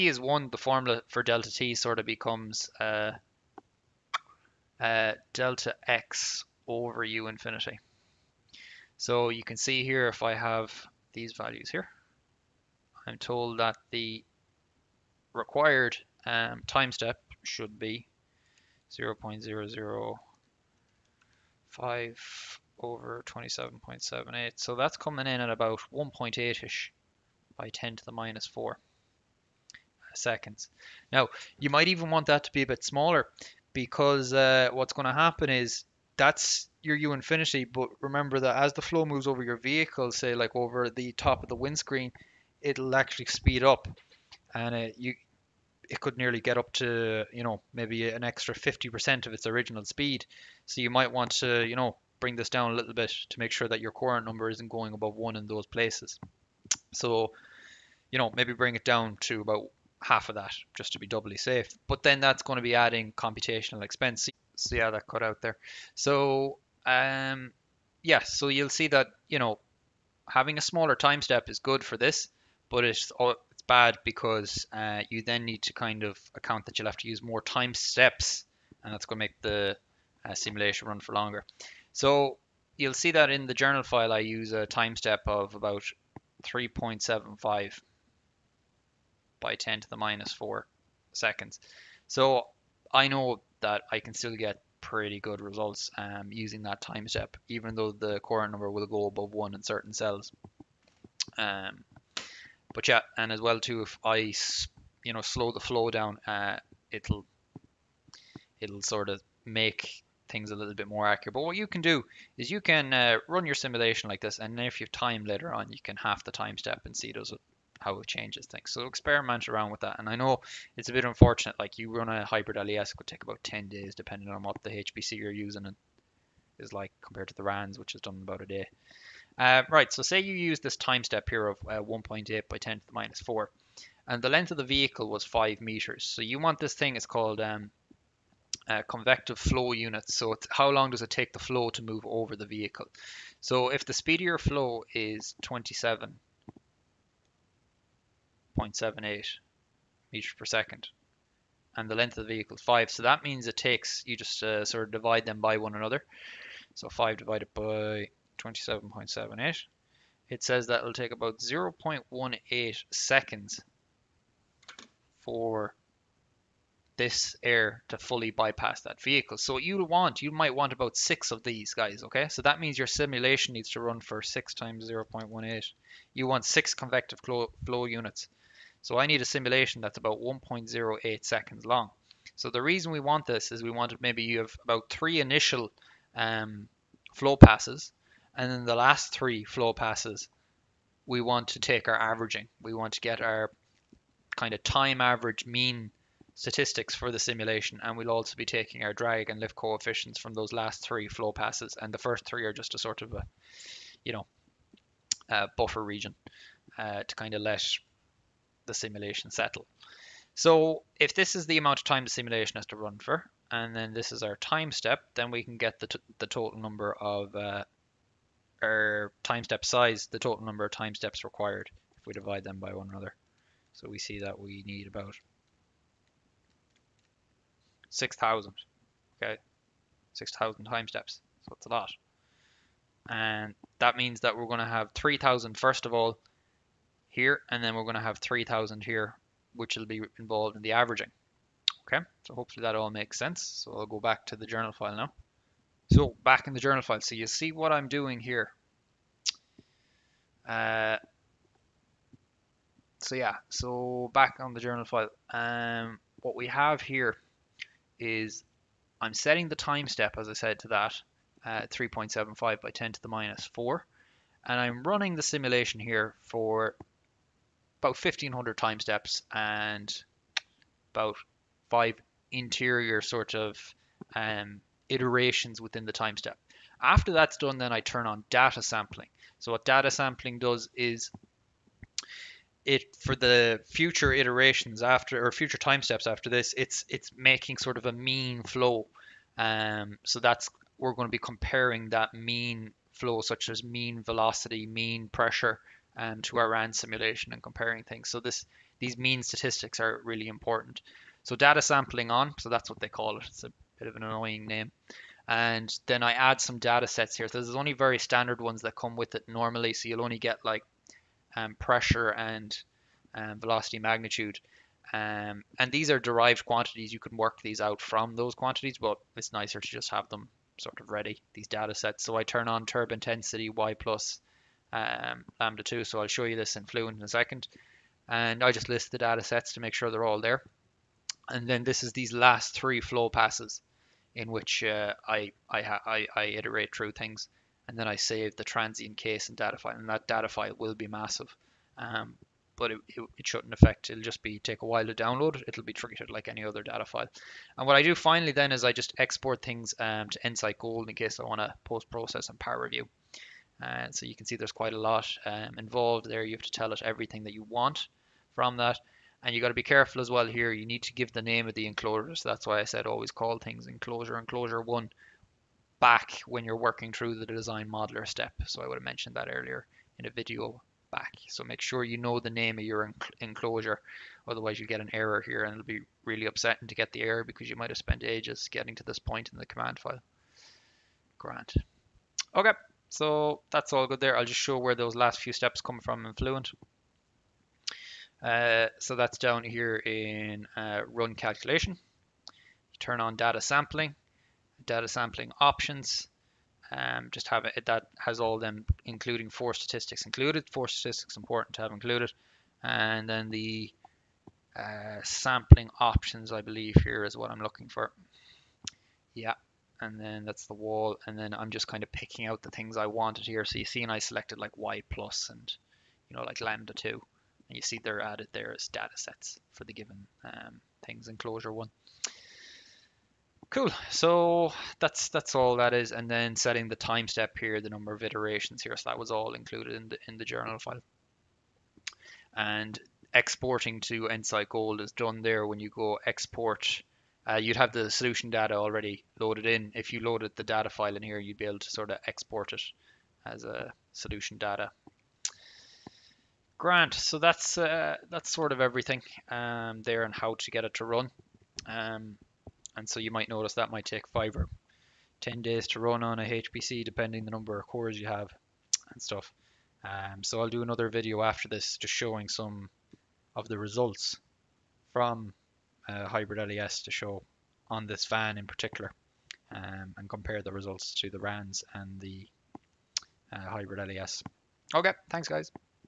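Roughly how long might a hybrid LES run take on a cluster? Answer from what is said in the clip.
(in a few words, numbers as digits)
10 days.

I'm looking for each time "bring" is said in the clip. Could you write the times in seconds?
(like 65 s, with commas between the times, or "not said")
52 s, 58 s.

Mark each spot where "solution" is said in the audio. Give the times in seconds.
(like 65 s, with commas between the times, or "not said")
437 s, 443 s.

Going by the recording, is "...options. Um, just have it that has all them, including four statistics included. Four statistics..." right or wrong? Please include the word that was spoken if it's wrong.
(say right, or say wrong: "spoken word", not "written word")
right.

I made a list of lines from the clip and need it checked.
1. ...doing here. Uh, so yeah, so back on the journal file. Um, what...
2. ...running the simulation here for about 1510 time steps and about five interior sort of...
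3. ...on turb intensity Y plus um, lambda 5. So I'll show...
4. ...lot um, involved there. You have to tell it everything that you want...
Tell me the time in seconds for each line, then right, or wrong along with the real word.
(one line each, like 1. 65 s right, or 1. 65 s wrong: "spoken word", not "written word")
1. 247 s right
2. 264 s wrong: "1500", not "1510"
3. 322 s wrong: "2", not "5"
4. 354 s right.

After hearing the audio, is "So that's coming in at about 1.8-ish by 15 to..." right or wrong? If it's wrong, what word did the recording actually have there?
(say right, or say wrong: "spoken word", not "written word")
wrong: "10", not "15".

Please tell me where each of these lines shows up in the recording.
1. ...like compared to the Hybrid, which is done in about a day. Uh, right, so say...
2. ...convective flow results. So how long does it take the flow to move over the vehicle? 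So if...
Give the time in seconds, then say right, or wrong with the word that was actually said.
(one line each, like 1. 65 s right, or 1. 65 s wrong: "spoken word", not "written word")
1. 126 s wrong: "RANs", not "Hybrid"
2. 138 s wrong: "units", not "results".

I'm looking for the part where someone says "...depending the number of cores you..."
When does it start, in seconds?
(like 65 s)
456 s.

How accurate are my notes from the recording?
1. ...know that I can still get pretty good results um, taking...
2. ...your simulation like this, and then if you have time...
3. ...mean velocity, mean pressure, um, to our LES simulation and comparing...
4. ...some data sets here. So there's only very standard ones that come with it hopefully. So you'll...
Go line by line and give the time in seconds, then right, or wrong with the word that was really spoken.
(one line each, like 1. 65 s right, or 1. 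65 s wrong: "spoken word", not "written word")
1. 93 s wrong: "using", not "taking"
2. 113 s right
3. 293 s wrong: "RAN", not "LES"
4. 306 s wrong: "normally", not "hopefully".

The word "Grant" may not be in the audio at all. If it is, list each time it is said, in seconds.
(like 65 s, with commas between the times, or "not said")
381 s, 446 s.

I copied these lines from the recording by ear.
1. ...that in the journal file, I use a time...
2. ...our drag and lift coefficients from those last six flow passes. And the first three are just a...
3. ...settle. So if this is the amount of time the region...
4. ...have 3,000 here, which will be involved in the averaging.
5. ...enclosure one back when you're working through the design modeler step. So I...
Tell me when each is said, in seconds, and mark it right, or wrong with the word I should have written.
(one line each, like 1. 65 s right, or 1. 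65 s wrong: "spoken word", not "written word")
1. 83 s right
2. 198 s wrong: "three", not "six"
3. 209 s wrong: "simulation", not "region"
4. 238 s right
5. 364 s right.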